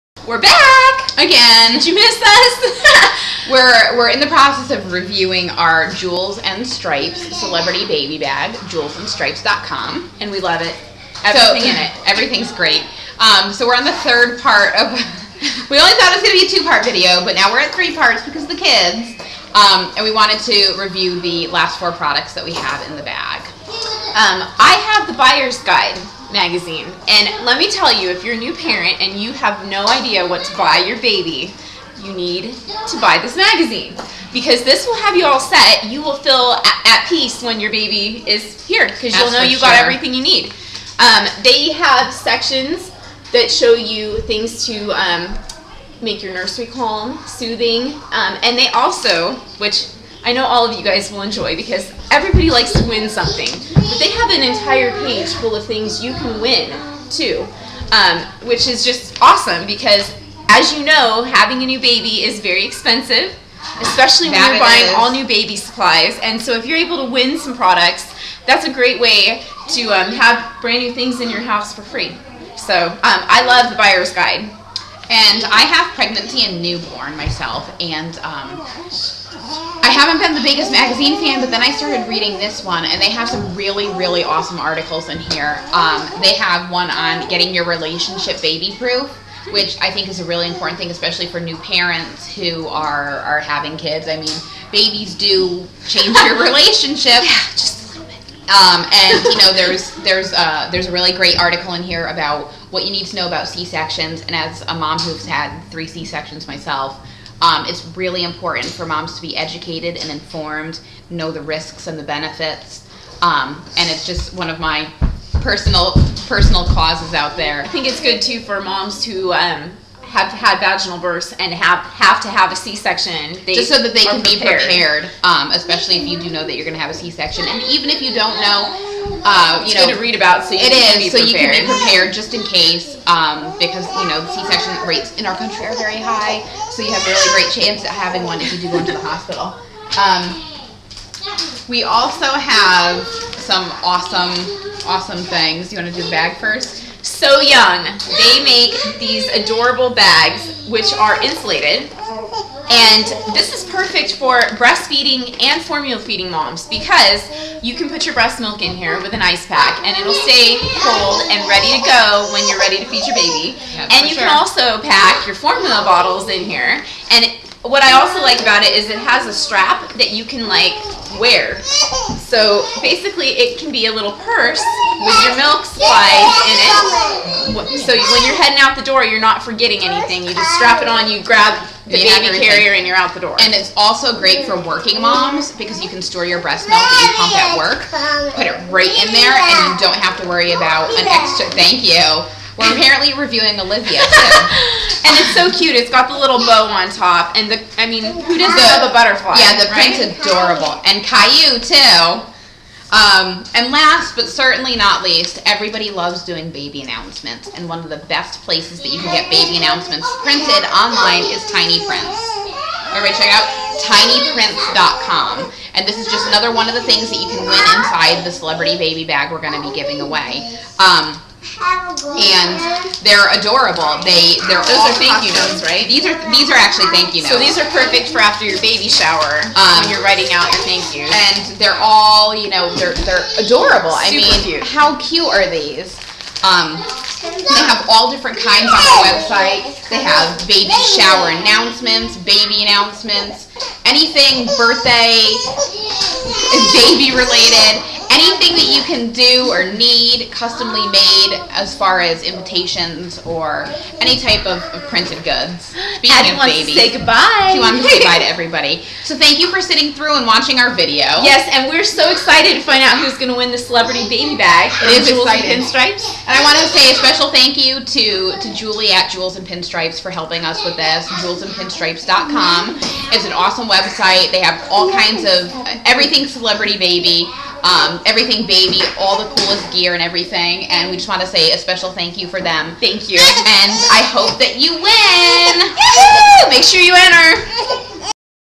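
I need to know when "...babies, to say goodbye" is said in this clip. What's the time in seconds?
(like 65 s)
256 s.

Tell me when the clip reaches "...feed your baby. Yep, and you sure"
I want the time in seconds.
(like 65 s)
162 s.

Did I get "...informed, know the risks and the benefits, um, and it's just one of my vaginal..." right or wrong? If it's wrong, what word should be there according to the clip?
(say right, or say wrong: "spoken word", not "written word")
wrong: "personal", not "vaginal".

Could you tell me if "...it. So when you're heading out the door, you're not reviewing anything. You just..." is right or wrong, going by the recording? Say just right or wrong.
wrong.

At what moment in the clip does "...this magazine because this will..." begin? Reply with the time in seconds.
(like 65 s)
33 s.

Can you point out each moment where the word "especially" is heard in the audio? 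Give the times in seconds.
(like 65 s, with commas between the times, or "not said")
63 s, 90 s, 125 s.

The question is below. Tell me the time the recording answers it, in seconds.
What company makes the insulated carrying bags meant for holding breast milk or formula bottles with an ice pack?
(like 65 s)
147 s.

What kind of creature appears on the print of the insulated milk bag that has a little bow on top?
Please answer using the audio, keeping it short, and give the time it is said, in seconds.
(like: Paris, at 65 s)
Butterfly, at 198 s.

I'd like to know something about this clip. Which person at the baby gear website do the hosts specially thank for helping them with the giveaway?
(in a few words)
Julie.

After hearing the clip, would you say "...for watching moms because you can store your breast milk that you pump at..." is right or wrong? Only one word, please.
wrong.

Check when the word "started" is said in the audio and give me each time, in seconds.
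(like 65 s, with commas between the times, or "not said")
81 s.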